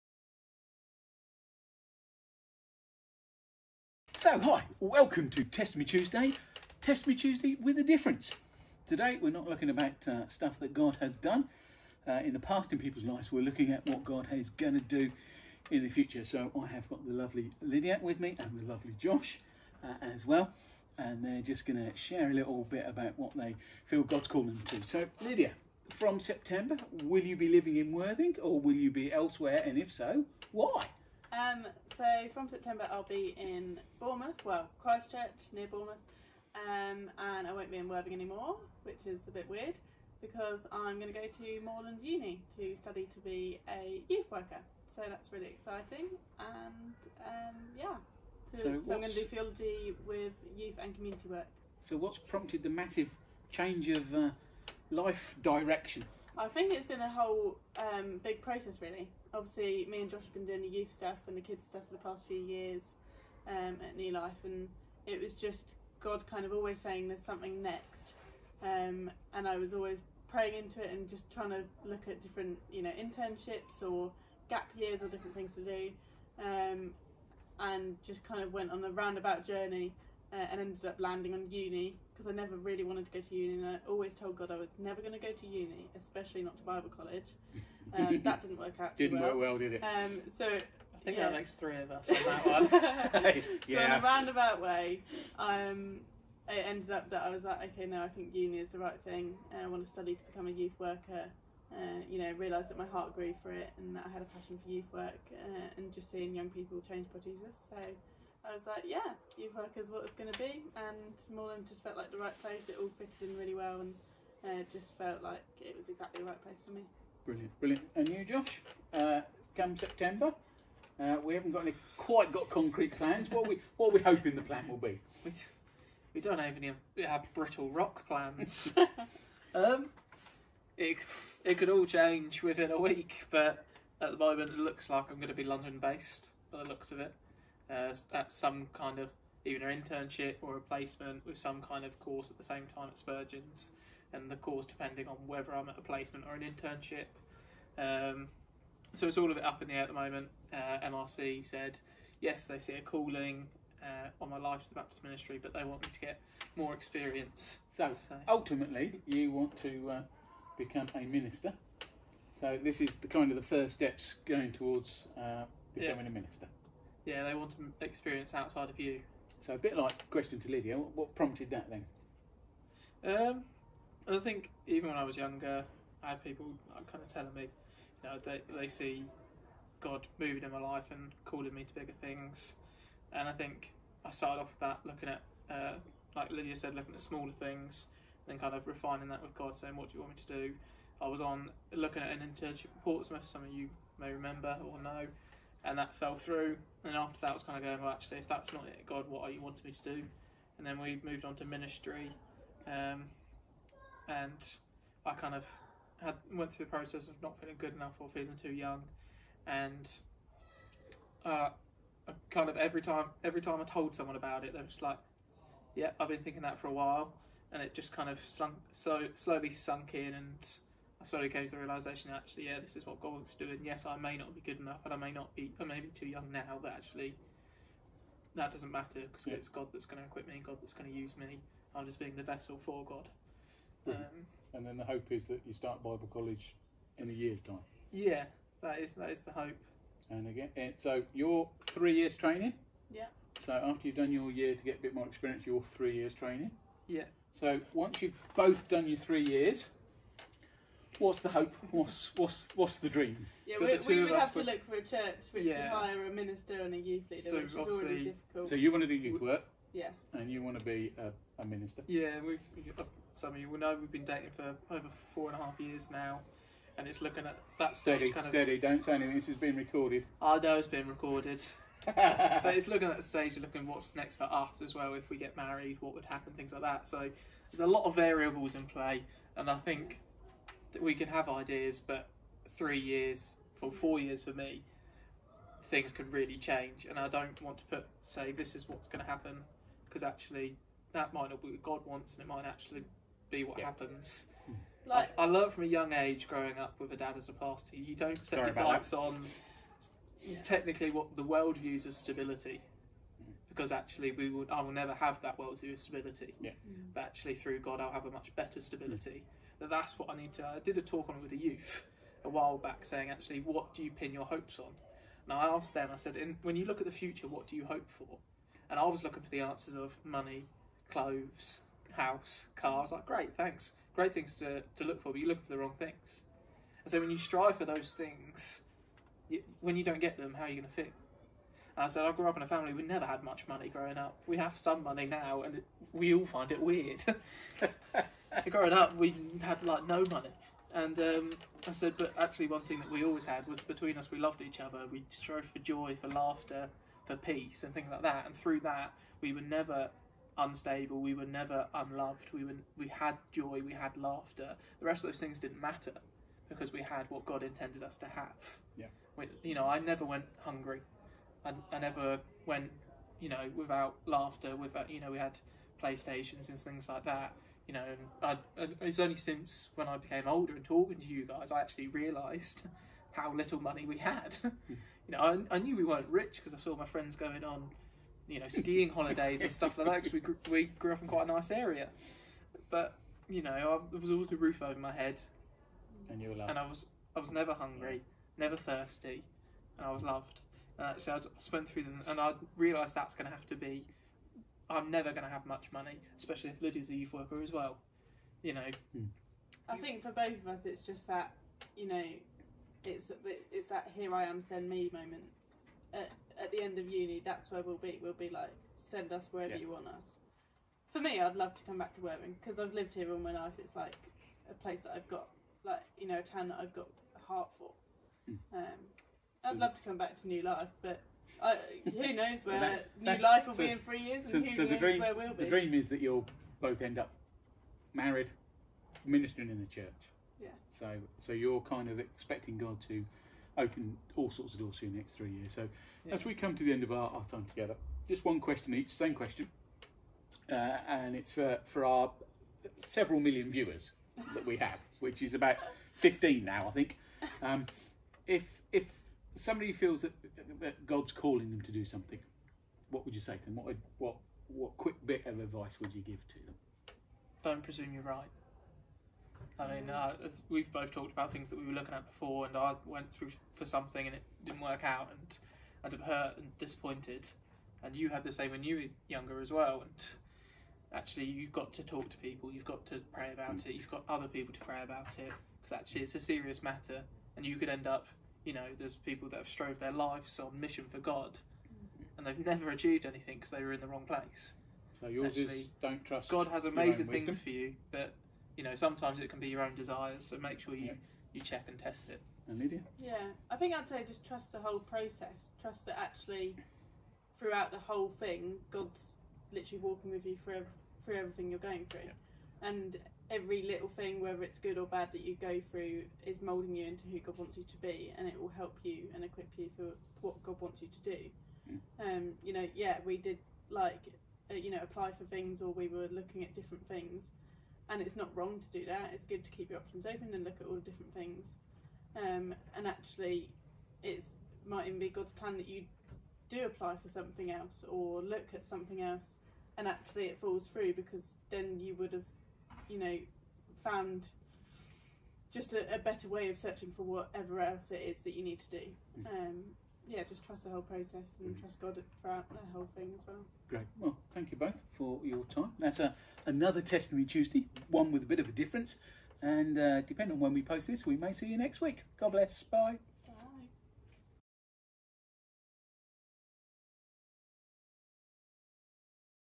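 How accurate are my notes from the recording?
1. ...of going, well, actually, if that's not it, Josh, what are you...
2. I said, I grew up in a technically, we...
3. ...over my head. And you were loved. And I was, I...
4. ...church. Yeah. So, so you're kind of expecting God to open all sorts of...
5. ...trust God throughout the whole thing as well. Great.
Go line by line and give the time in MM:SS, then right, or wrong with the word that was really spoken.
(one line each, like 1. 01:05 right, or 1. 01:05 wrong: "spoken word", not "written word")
1. 03:17 wrong: "God", not "Josh"
2. 05:31 wrong: "family", not "technically"
3. 06:24 right
4. 07:09 right
5. 09:01 right.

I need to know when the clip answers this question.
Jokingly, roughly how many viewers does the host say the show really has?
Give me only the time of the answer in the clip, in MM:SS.
07:25.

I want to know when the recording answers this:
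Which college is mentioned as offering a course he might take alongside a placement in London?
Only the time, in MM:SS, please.
02:22.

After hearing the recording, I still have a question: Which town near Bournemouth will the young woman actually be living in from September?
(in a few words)
Christchurch.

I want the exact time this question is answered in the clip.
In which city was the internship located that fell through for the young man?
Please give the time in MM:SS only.
03:12.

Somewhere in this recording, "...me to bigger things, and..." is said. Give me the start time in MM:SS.
03:01.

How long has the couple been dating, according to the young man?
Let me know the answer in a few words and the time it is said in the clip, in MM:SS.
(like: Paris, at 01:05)
Four and a half years, at 04:25.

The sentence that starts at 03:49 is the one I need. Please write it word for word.
it's God that's going to equip me, and God that's going to use me.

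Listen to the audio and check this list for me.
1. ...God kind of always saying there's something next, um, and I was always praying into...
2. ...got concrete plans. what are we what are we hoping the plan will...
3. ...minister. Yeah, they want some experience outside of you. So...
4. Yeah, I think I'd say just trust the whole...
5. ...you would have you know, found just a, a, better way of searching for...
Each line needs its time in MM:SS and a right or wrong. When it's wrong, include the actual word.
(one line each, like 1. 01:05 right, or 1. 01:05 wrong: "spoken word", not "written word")
1. 01:05 right
2. 02:02 right
3. 02:46 right
4. 08:12 right
5. 08:51 right.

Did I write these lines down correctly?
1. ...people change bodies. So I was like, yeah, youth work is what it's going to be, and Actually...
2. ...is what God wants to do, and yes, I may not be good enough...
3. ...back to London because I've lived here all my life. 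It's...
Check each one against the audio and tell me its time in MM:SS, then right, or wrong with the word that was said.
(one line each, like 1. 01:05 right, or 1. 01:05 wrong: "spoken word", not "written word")
1. 01:46 wrong: "Moorland", not "Actually"
2. 03:42 right
3. 06:51 wrong: "Worthing", not "London".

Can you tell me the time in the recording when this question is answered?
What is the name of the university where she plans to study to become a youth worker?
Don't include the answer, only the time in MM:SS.
00:41.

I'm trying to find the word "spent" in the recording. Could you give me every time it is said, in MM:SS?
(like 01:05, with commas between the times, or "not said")
06:31.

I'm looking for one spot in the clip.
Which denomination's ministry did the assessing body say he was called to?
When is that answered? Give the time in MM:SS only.
02:34.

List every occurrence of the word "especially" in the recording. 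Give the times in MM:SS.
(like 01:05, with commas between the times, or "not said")
01:25, 06:36.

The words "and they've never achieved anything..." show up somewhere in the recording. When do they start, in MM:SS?
08:02.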